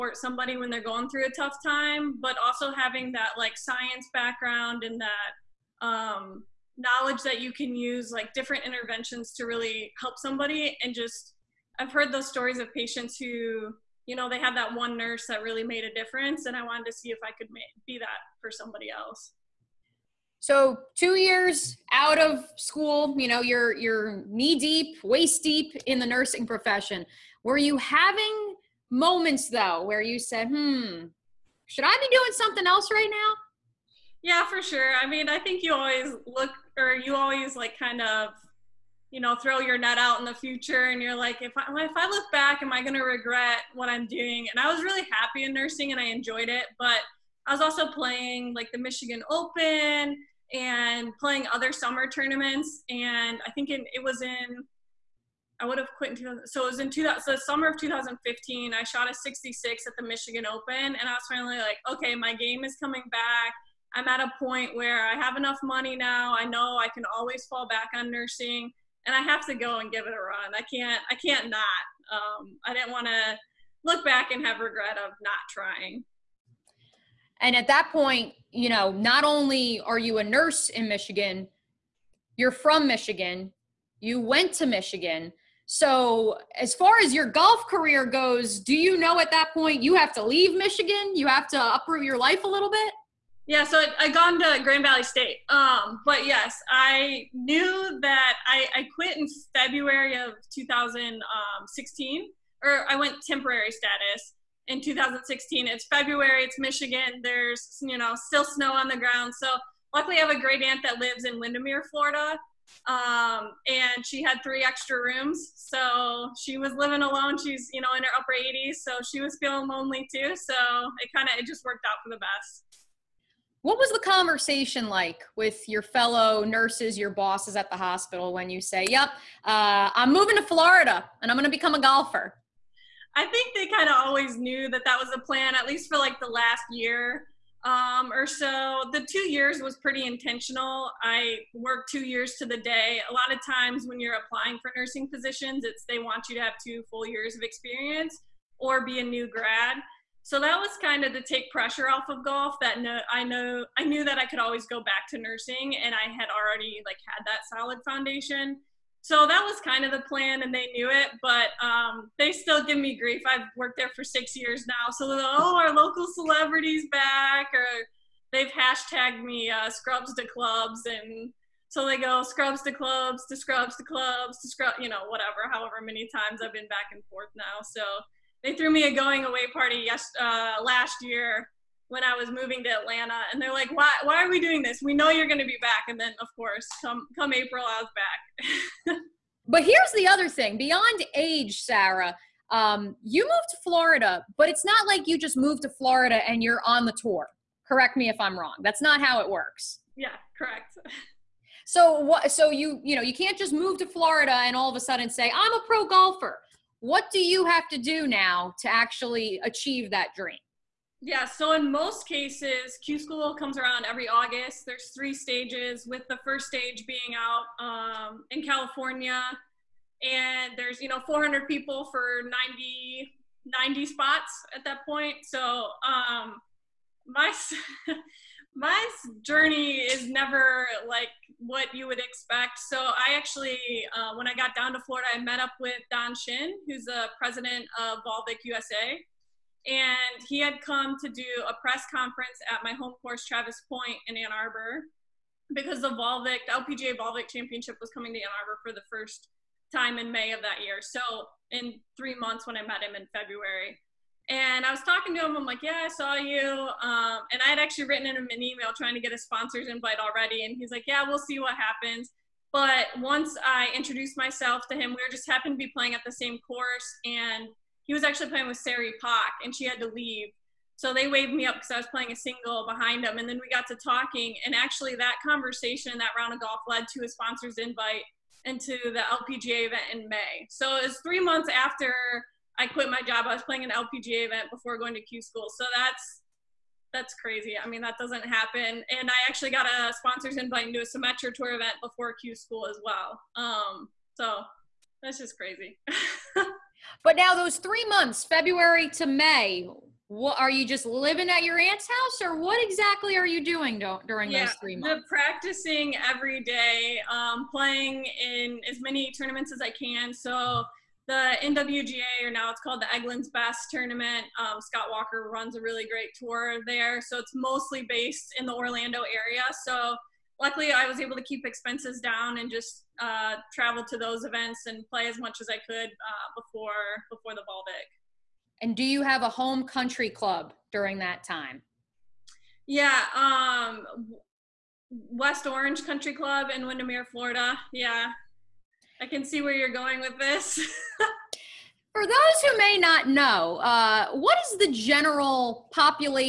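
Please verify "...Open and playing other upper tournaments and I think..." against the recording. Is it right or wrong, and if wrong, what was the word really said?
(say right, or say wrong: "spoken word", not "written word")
wrong: "summer", not "upper".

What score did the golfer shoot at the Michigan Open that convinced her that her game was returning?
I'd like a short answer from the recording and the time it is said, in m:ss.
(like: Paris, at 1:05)
66, at 0:59.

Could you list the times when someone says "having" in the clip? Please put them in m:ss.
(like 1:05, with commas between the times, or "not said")
0:02, 0:27.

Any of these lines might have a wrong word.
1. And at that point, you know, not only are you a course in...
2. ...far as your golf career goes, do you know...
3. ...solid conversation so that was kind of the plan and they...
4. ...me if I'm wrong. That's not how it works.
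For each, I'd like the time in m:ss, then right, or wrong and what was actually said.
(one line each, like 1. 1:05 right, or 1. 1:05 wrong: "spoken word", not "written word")
1. 1:17 wrong: "nurse", not "course"
2. 1:26 right
3. 2:37 wrong: "foundation", not "conversation"
4. 3:17 right.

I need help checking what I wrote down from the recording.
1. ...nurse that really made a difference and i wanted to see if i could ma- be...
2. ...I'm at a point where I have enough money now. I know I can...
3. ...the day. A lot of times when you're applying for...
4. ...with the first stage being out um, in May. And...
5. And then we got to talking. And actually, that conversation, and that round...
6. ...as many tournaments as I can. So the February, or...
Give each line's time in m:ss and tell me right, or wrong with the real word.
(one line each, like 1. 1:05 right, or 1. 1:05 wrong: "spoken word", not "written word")
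1. 0:14 right
2. 1:03 right
3. 2:22 right
4. 3:35 wrong: "California", not "May"
5. 4:33 right
6. 5:08 wrong: "NWGA", not "February".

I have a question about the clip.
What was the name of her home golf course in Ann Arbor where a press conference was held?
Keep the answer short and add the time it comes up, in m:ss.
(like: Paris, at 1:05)
Travis Pointe, at 4:03.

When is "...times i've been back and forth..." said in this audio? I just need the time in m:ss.
2:56.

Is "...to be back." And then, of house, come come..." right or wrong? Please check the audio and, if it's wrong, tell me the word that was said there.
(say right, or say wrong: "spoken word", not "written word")
wrong: "course", not "house".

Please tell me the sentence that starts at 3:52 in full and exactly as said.
So I actually, uh, when I got down to Florida, I met up with Don Shin, who's the president of Volvik USA.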